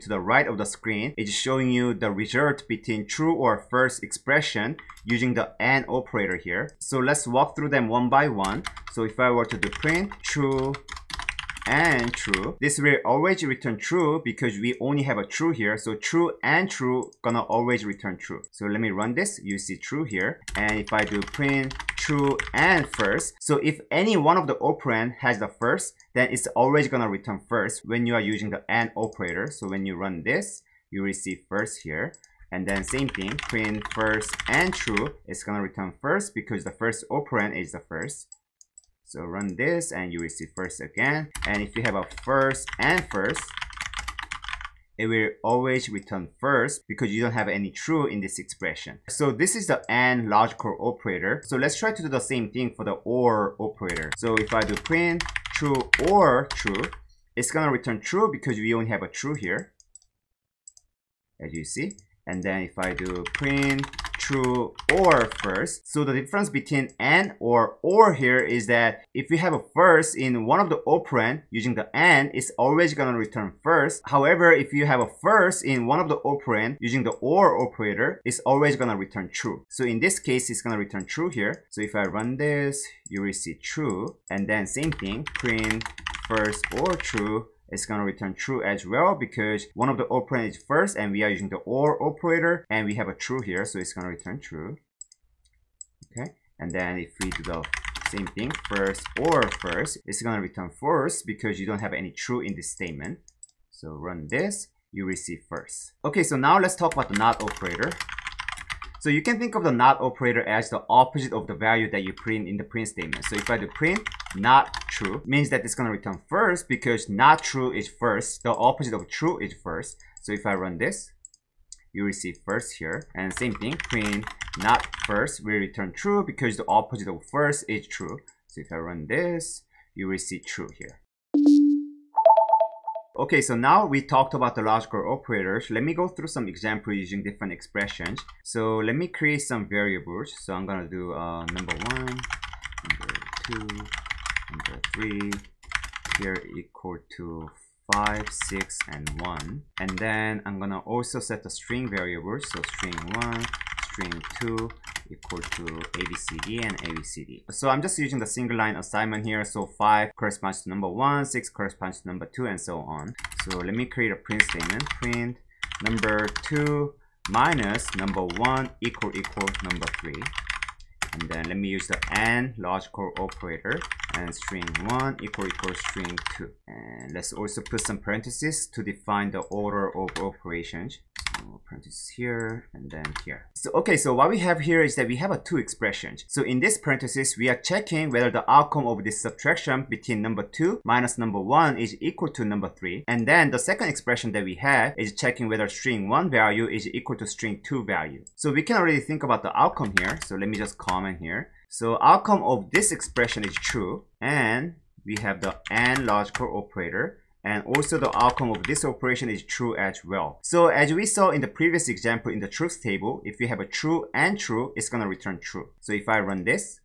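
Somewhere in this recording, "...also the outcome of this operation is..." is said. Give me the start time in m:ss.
3:27.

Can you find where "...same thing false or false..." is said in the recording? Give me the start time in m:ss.
1:38.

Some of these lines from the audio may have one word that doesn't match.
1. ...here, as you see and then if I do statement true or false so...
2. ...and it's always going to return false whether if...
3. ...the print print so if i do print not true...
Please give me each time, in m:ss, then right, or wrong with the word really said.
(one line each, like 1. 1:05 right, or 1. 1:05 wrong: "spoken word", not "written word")
1. 0:59 wrong: "print", not "statement"
2. 1:11 wrong: "however", not "whether"
3. 1:52 wrong: "statement", not "print".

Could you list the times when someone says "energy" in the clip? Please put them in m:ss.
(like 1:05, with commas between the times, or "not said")
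not said.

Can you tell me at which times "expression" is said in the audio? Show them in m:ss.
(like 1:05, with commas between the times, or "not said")
0:03, 0:48, 2:17, 3:05, 3:13, 3:22.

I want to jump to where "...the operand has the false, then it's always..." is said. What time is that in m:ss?
0:24.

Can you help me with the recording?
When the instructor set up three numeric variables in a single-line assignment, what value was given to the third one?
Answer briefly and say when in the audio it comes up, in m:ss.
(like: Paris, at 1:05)
1, at 2:27.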